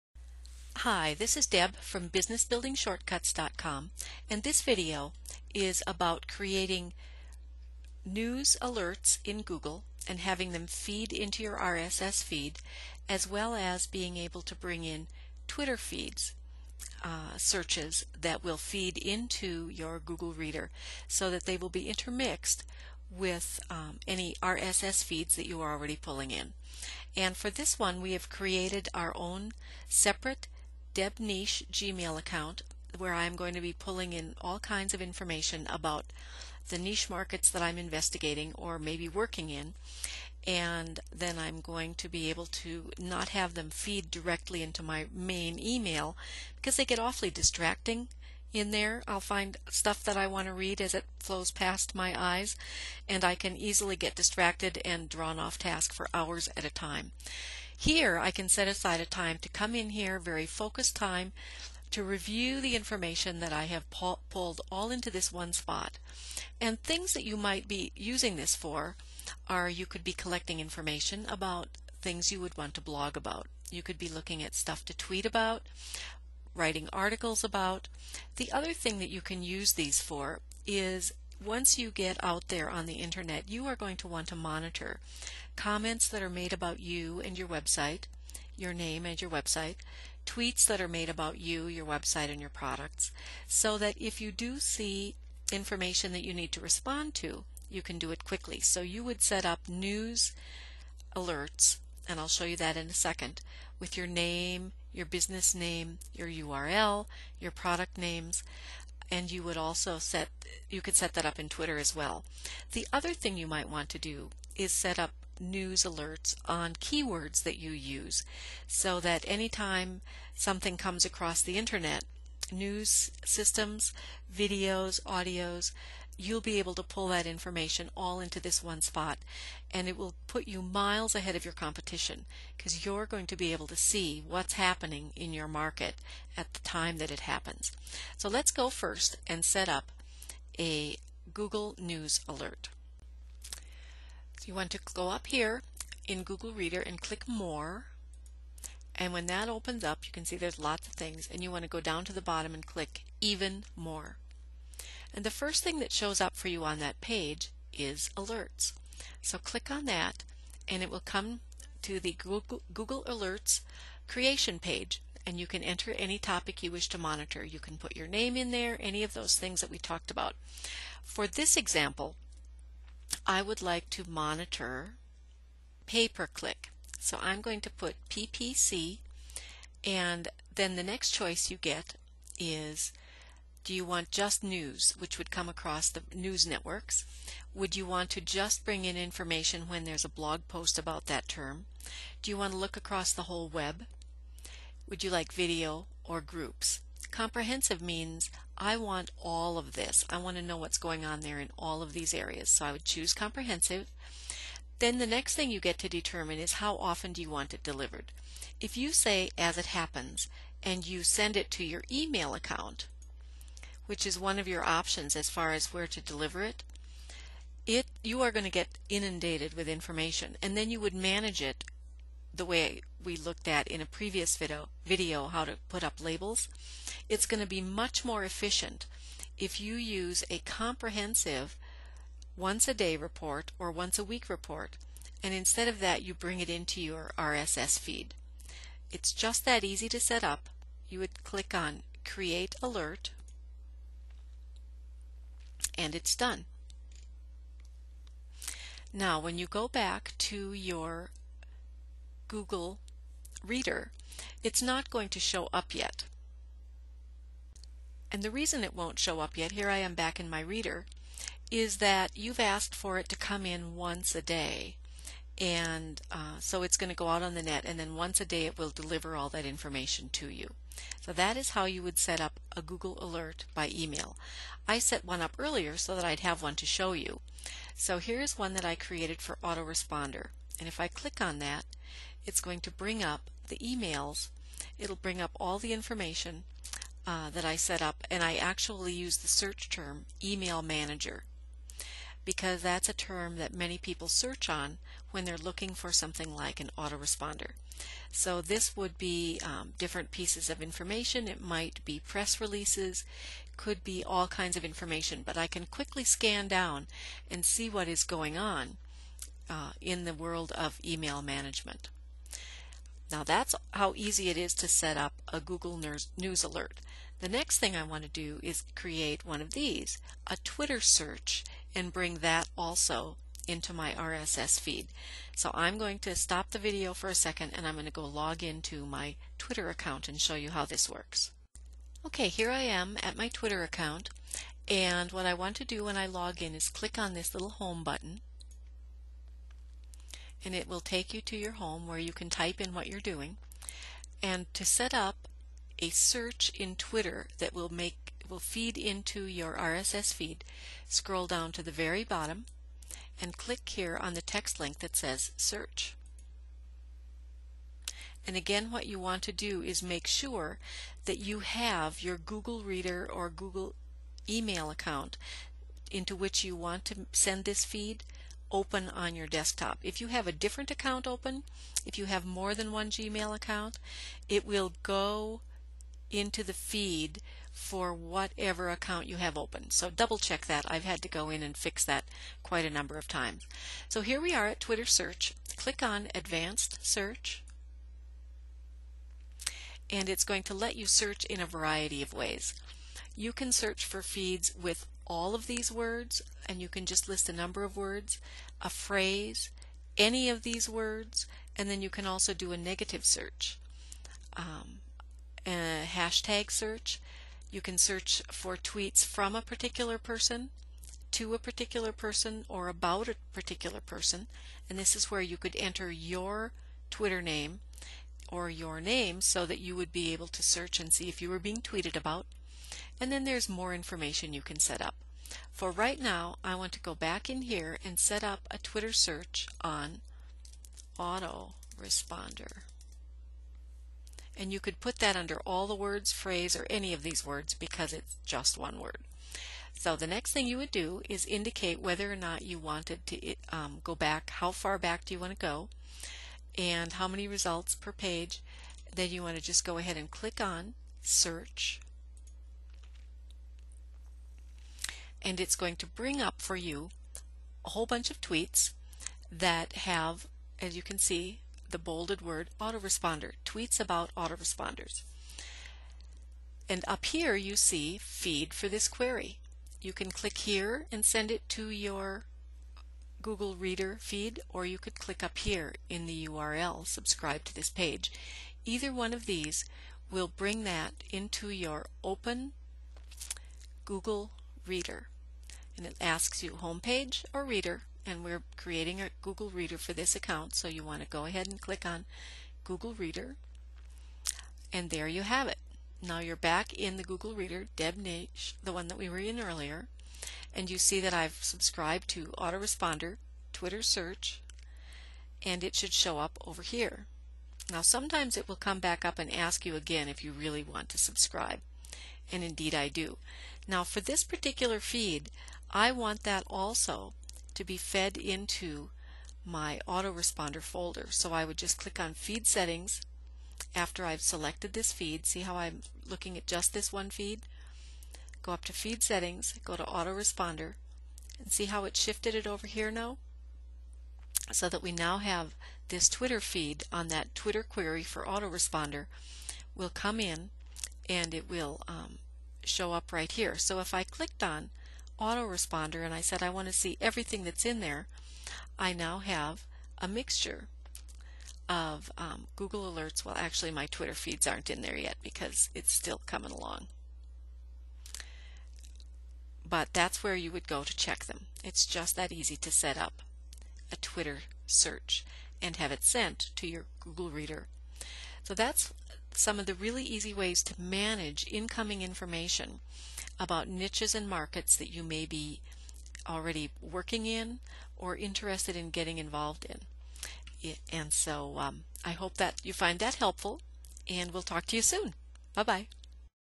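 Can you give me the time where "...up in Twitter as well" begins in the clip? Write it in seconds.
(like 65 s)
111 s.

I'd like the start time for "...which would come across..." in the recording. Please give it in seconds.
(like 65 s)
184 s.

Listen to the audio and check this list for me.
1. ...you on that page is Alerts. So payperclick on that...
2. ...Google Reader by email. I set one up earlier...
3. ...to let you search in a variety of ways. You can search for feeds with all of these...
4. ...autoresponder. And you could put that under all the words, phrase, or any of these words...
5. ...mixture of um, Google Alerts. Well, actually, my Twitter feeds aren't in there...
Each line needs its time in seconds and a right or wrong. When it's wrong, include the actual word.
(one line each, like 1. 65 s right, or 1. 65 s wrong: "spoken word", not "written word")
1. 156 s wrong: "click", not "payperclick"
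2. 272 s wrong: "Alert", not "Reader"
3. 390 s right
4. 430 s right
5. 550 s right.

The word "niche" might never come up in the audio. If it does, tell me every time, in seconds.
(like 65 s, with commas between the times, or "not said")
31 s, 36 s, 573 s.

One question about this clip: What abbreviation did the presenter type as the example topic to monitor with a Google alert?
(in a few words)
PPC.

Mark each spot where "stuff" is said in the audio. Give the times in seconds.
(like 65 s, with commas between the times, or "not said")
49 s, 74 s.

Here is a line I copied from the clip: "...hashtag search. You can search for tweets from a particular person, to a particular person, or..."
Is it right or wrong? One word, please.
right.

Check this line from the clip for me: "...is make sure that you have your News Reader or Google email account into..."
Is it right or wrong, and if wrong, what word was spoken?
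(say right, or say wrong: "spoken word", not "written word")
wrong: "Google", not "News".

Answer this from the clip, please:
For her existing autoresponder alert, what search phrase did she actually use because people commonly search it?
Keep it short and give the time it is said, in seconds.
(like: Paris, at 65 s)
email manager, at 290 s.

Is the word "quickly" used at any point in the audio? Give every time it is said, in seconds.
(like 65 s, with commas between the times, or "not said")
98 s, 305 s.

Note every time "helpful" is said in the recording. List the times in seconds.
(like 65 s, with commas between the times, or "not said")
583 s.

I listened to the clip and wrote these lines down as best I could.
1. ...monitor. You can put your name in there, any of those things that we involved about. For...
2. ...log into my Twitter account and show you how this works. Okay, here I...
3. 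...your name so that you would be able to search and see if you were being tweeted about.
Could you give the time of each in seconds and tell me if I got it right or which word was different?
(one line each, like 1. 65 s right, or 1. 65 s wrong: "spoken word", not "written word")
1. 166 s wrong: "talked", not "involved"
2. 328 s right
3. 418 s right.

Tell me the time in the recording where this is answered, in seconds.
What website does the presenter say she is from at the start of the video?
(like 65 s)
2 s.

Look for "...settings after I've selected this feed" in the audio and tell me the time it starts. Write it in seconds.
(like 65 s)
522 s.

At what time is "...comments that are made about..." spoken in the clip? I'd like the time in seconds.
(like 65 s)
85 s.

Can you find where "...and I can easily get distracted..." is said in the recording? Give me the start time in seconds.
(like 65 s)
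53 s.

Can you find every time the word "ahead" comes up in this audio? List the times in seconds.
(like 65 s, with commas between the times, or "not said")
131 s, 449 s, 491 s.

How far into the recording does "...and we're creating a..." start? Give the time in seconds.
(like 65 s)
488 s.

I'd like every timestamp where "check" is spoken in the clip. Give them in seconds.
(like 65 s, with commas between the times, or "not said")
380 s, 560 s.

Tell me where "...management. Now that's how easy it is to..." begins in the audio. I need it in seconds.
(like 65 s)
311 s.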